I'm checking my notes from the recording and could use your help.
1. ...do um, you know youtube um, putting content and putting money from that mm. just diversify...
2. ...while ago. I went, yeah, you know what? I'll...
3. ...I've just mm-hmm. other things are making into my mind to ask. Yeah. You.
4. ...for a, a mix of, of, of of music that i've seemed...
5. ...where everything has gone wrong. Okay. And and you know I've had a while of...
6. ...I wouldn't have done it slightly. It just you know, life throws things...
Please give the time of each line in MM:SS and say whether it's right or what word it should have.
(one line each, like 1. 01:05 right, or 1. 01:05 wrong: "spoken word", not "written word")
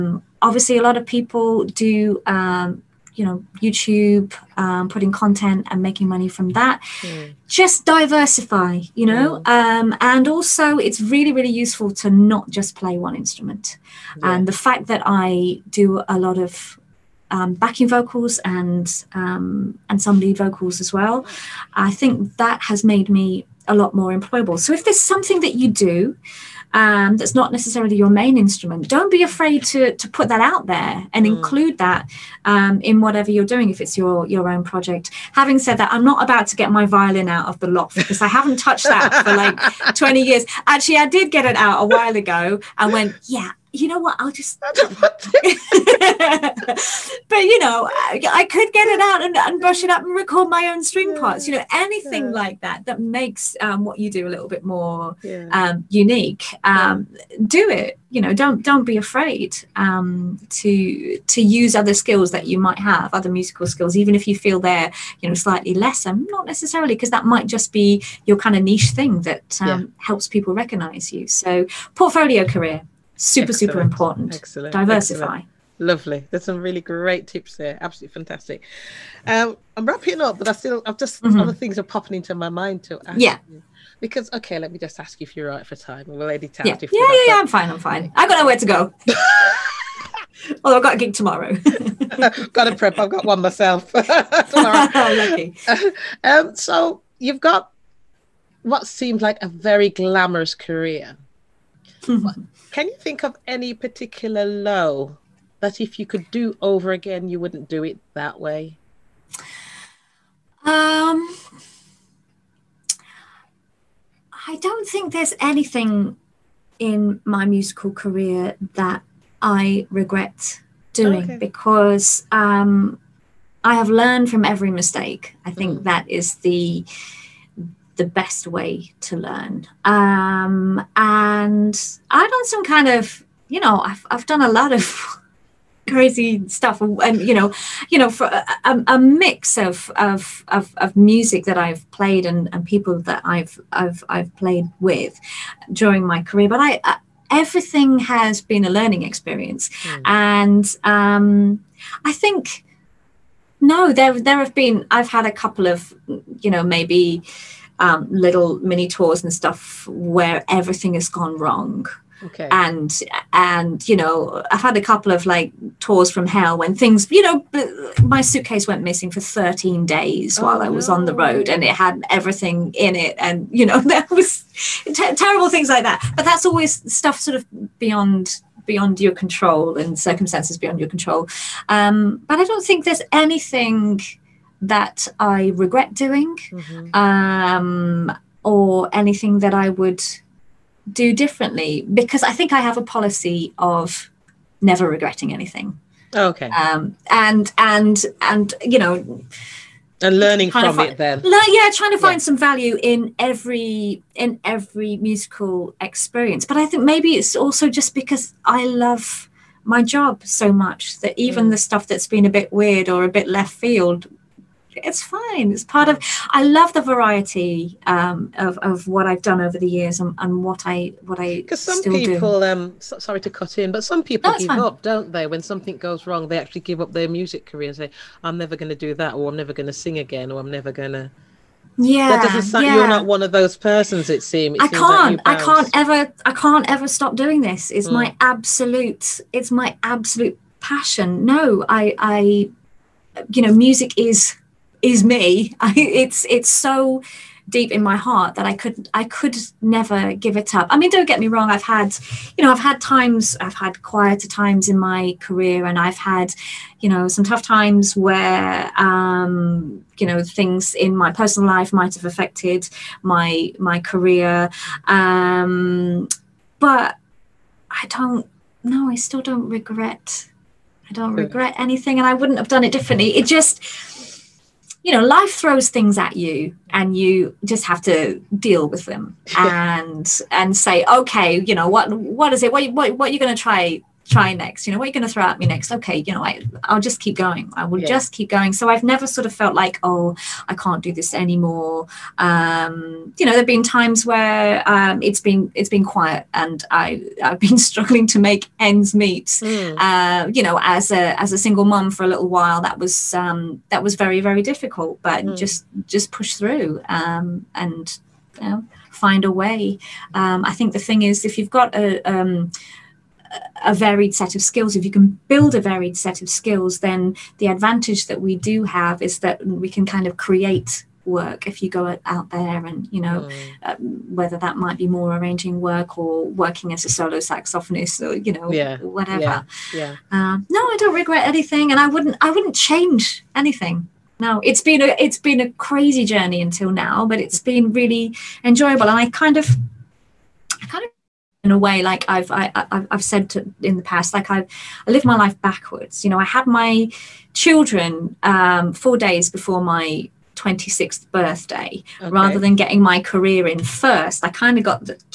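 1. 00:01 wrong: "making", not "putting"
2. 00:41 right
3. 01:20 wrong: "popping", not "making"
4. 02:18 wrong: "played", not "seemed"
5. 02:39 wrong: "couple", not "while"
6. 04:32 wrong: "differently", not "slightly".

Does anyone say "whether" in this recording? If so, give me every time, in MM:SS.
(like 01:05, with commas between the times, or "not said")
05:24.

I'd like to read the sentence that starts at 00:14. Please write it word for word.
and the fact that i do a lot of um, backing vocals and um, and some lead vocals as well.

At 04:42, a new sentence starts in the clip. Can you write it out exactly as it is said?
What what, what are you gonna try try next?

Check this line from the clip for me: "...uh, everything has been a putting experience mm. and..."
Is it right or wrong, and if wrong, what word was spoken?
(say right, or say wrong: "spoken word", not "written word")
wrong: "learning", not "putting".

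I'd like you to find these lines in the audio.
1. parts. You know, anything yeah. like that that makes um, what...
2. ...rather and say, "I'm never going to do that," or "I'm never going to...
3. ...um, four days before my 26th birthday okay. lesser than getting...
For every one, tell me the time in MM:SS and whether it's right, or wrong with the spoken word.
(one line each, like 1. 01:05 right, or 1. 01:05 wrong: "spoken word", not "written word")
1. 00:51 right
2. 03:47 wrong: "career", not "rather"
3. 05:48 wrong: "rather", not "lesser".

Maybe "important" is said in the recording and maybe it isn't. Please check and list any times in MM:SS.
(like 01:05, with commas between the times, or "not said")
01:13.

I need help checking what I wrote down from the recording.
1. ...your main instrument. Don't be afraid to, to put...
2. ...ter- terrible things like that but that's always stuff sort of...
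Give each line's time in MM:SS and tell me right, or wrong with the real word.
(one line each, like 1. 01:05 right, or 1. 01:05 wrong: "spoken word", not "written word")
1. 00:27 right
2. 02:54 right.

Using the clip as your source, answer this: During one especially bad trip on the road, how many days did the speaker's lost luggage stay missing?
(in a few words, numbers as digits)
13.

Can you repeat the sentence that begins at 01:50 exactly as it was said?
Um, I don't think there's anything in my musical career that I regret doing okay.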